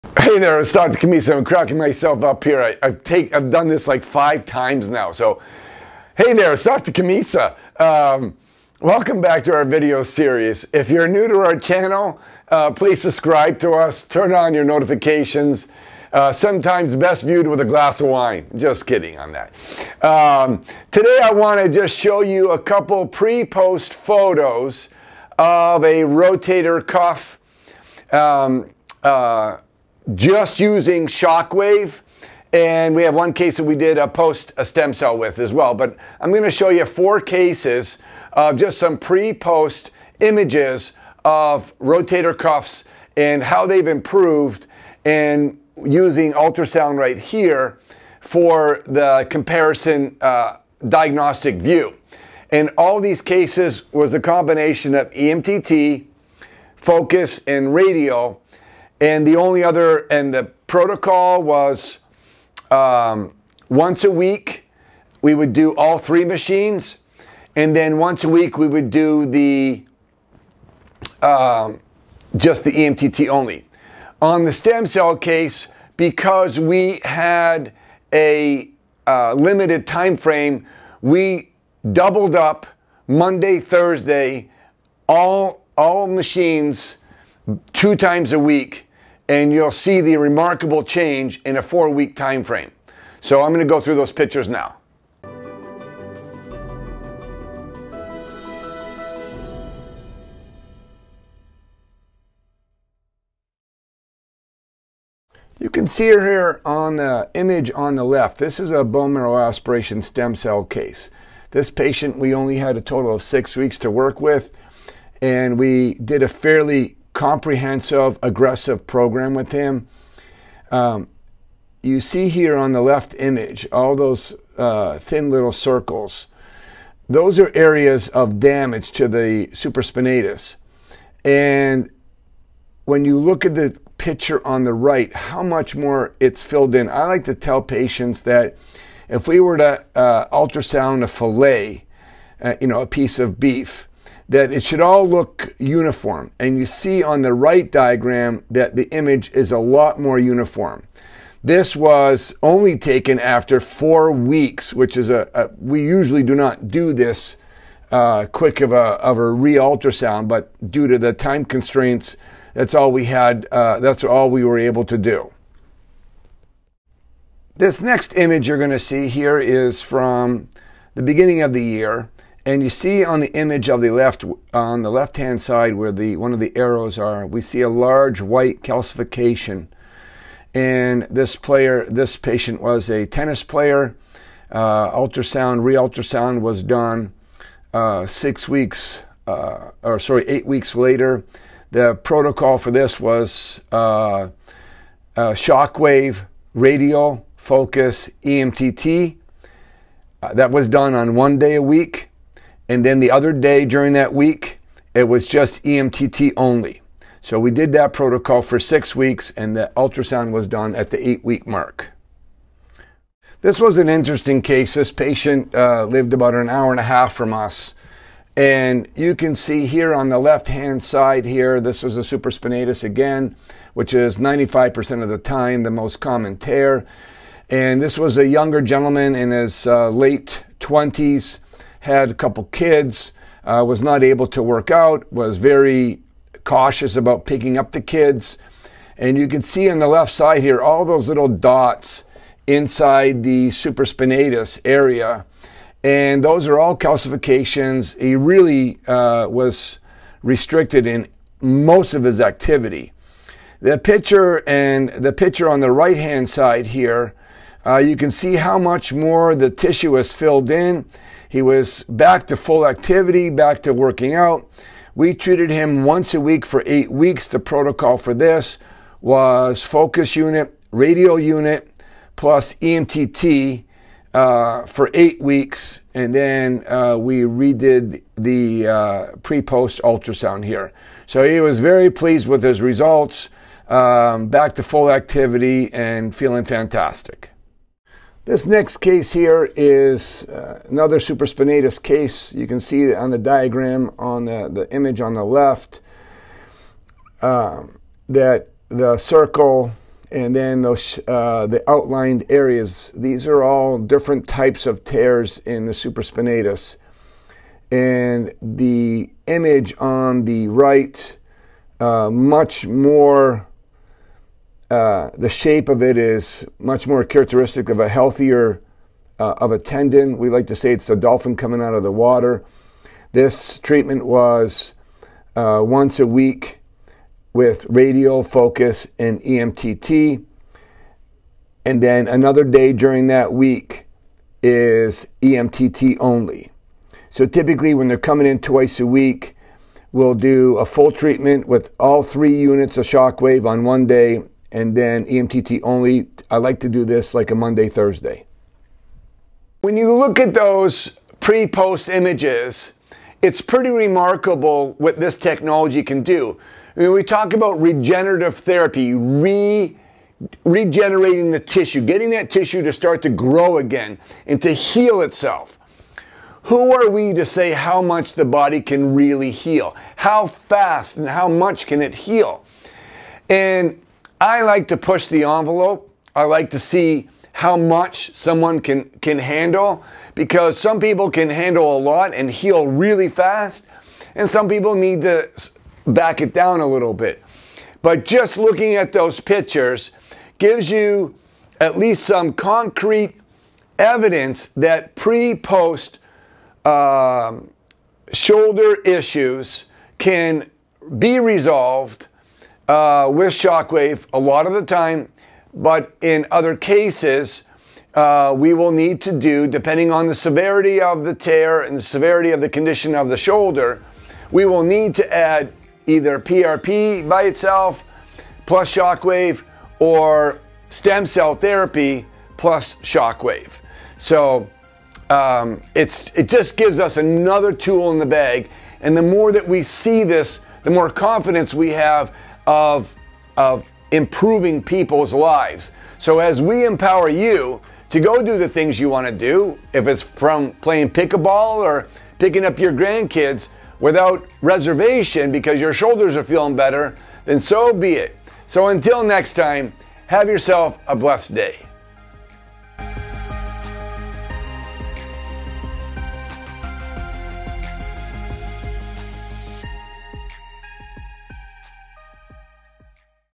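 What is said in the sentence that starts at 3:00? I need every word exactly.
And this player, this patient was a tennis player.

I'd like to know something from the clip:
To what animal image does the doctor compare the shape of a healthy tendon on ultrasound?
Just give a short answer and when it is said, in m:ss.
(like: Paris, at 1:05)
a dolphin, at 5:20.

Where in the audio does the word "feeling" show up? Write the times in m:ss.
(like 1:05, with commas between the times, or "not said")
4:46, 7:26.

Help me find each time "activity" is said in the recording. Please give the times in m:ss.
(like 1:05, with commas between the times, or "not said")
4:12, 4:22, 4:44.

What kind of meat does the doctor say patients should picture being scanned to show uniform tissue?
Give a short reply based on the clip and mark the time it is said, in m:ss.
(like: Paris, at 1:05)
a fillet, at 2:21.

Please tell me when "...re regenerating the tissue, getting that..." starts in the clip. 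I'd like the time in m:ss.
5:58.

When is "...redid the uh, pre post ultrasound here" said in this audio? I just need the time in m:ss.
4:37.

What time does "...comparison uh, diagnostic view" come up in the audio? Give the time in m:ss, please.
0:49.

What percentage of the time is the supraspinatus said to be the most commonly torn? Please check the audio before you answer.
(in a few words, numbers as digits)
95%.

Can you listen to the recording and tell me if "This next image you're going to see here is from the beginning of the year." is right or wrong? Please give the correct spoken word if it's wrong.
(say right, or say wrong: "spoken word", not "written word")
right.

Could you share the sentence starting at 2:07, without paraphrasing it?
Those are areas of damage to the supraspinatus.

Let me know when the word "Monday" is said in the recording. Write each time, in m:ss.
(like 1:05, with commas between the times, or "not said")
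1:23, 5:47.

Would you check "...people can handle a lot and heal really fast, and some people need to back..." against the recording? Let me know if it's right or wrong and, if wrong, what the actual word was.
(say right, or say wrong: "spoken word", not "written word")
right.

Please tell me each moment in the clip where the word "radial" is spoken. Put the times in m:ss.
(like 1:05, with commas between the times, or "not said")
0:57, 3:16, 4:30, 5:27.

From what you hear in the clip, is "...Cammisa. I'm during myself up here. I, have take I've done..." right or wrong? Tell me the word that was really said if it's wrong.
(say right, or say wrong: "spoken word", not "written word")
wrong: "cracking", not "during".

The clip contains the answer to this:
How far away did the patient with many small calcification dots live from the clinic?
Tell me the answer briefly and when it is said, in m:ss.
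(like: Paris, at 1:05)
an hour and a half, at 3:36.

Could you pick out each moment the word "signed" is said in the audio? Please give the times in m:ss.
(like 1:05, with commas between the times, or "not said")
not said.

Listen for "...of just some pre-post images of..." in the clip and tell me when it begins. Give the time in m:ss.
0:38.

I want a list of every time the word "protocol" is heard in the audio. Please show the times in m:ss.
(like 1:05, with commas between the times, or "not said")
1:00, 3:11, 3:27, 4:27.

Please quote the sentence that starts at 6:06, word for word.
Who are we to say how much the body can really heal?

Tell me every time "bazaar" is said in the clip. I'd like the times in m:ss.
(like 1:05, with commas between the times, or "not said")
not said.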